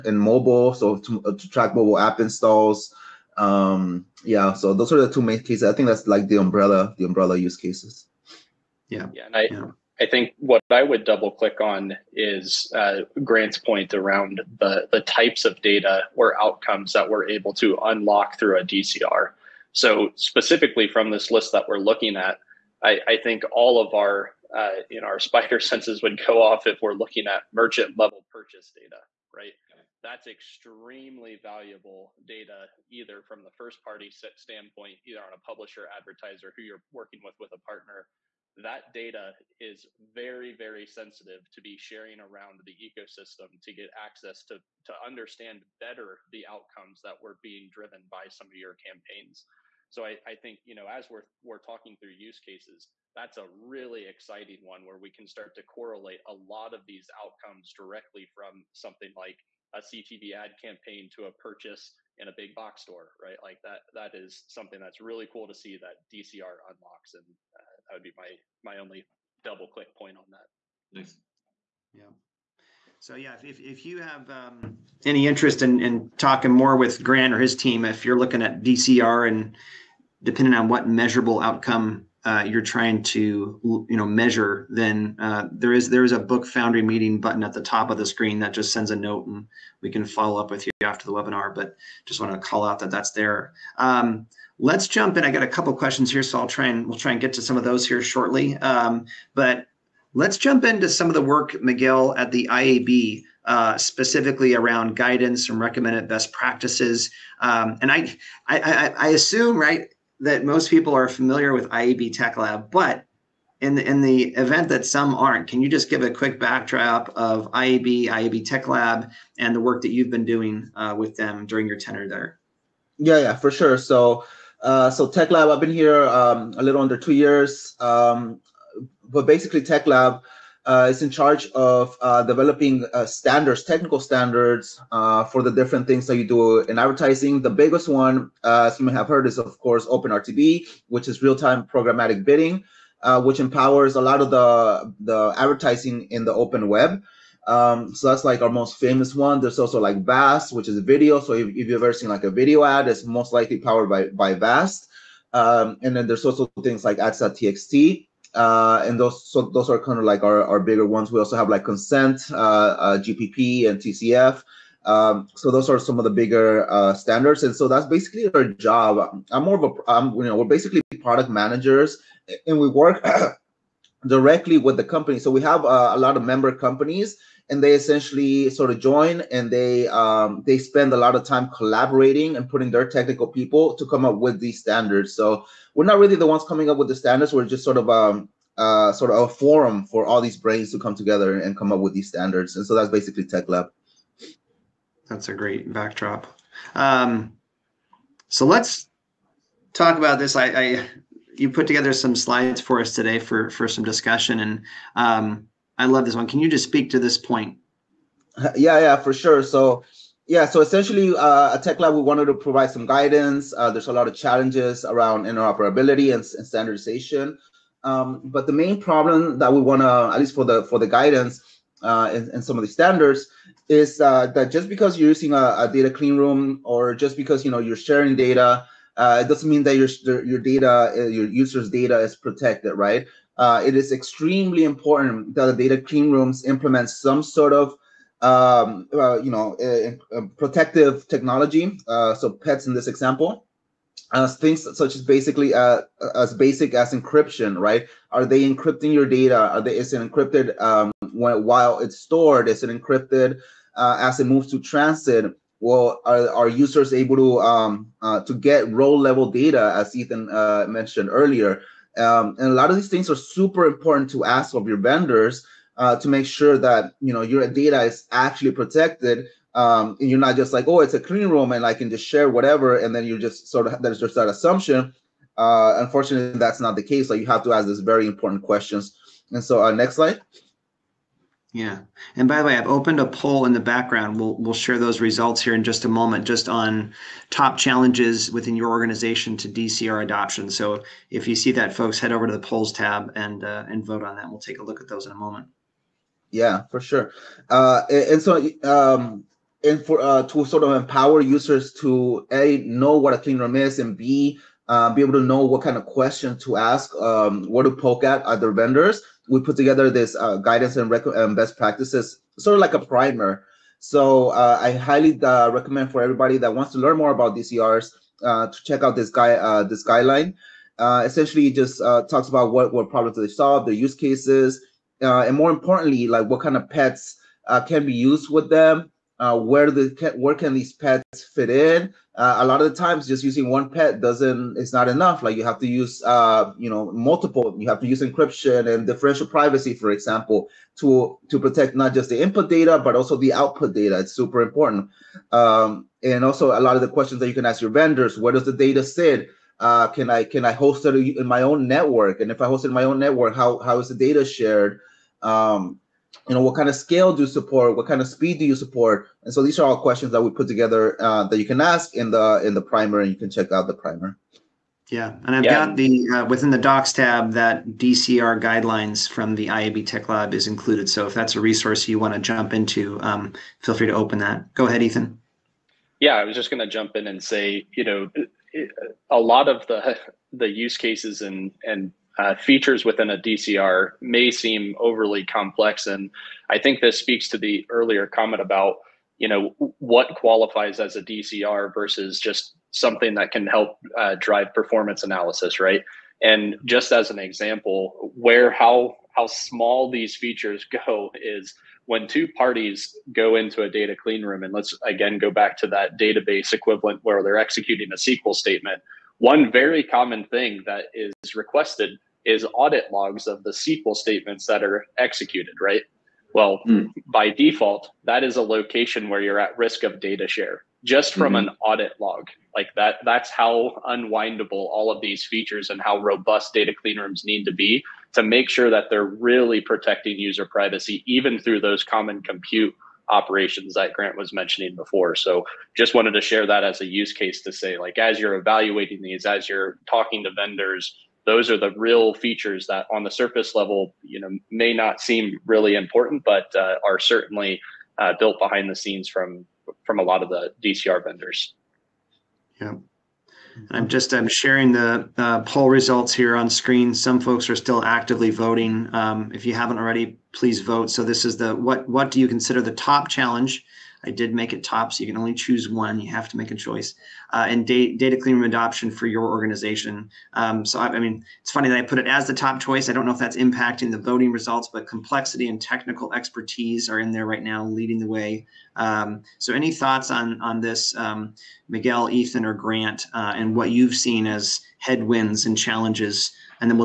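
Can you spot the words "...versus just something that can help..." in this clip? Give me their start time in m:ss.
6:31.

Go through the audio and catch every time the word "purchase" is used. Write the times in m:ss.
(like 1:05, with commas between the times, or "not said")
0:28, 1:01.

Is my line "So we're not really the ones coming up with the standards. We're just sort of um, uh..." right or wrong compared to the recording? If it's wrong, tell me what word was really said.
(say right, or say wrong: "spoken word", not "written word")
right.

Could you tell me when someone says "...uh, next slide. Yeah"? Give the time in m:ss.
4:39.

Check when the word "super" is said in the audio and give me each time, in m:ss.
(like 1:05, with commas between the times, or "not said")
4:23, 5:44.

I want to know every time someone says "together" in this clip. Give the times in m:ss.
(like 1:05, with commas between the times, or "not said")
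3:10, 3:21, 5:09, 6:00.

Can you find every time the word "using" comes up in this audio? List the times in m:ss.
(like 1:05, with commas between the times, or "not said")
3:45, 5:33.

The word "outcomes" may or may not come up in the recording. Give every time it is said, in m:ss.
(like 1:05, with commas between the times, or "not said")
0:16, 0:46, 0:57, 1:21.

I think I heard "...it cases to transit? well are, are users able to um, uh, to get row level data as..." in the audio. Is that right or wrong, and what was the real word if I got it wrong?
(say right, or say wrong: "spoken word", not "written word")
wrong: "moves", not "cases".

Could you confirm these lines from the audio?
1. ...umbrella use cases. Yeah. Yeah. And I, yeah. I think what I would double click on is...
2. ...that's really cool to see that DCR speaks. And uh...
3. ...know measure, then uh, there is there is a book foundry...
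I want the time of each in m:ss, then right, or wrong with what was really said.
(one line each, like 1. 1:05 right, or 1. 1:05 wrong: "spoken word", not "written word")
1. 0:07 right
2. 1:04 wrong: "unlocks", not "speaks"
3. 1:23 right.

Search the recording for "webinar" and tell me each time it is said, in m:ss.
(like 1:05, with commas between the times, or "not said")
1:31.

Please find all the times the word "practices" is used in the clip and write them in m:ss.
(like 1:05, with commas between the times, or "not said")
1:46, 5:11.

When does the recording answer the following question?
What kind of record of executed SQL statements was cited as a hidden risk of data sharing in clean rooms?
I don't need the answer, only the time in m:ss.
6:52.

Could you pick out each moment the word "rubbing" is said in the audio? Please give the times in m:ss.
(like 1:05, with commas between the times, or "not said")
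not said.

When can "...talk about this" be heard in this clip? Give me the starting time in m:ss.
3:19.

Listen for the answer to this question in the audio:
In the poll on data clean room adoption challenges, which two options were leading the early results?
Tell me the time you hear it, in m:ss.
7:54.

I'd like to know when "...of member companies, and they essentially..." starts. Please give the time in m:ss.
2:56.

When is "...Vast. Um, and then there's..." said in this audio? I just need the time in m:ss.
2:34.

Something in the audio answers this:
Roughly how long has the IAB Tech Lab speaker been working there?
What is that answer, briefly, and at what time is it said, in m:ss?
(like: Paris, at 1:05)
A little under two years, at 2:06.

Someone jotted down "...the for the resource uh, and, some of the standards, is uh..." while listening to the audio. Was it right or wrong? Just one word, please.
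wrong.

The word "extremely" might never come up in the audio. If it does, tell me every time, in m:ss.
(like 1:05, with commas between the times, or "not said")
0:30, 3:53.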